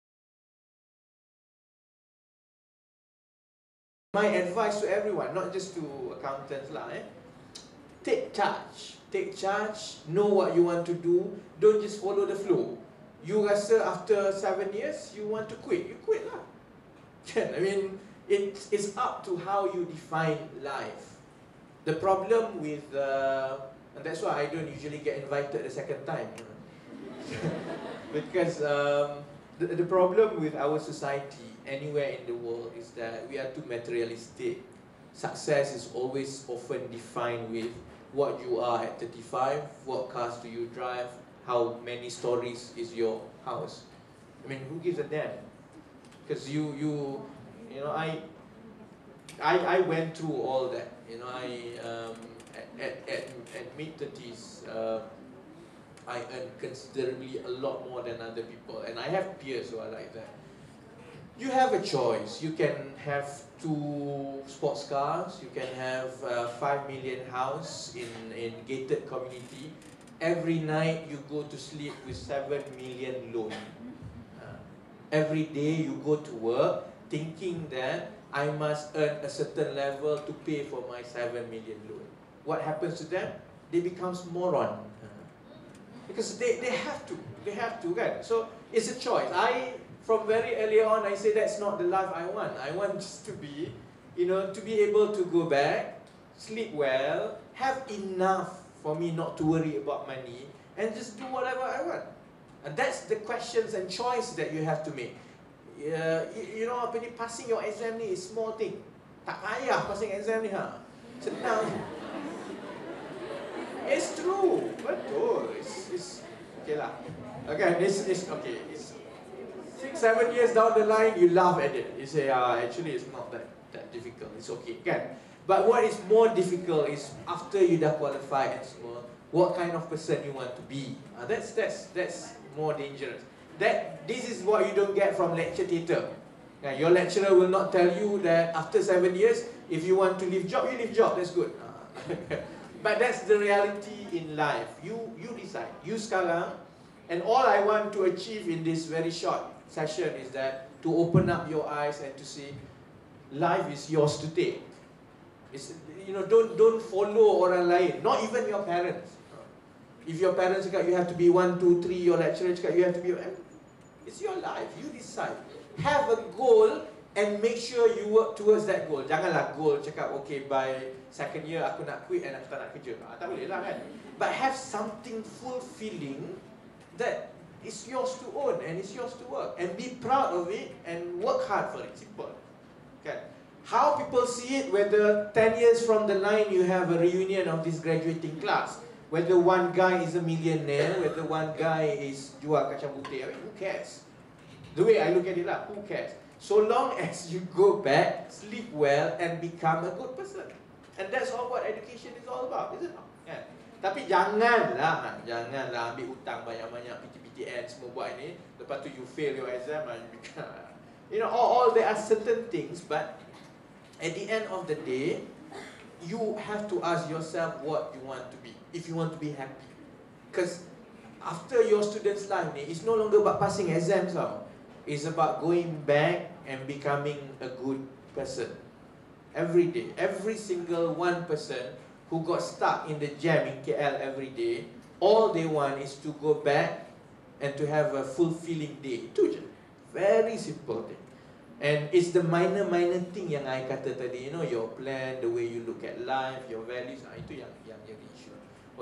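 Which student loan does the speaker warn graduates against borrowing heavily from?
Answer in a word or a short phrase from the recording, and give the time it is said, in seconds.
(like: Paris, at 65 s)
PTPTN, at 206 s.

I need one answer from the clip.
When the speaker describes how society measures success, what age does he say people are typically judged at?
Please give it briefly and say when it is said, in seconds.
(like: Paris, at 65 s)
35, at 38 s.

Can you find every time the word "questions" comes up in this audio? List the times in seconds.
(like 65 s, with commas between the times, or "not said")
103 s.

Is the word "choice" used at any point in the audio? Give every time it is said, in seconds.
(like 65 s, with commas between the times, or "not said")
61 s, 88 s, 103 s.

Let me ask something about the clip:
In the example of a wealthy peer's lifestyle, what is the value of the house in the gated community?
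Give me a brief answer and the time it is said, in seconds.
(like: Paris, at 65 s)
5 million, at 66 s.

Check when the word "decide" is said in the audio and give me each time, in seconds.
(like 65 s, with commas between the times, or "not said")
145 s, 164 s.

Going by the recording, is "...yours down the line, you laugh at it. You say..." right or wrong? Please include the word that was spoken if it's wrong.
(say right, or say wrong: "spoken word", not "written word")
wrong: "years", not "yours".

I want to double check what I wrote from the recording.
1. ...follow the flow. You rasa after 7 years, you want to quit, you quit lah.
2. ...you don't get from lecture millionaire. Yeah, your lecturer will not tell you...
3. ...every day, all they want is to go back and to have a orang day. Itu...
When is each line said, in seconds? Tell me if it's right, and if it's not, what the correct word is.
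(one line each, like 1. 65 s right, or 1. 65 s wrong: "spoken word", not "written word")
1. 12 s right
2. 134 s wrong: "theatre", not "millionaire"
3. 234 s wrong: "fulfilling", not "orang".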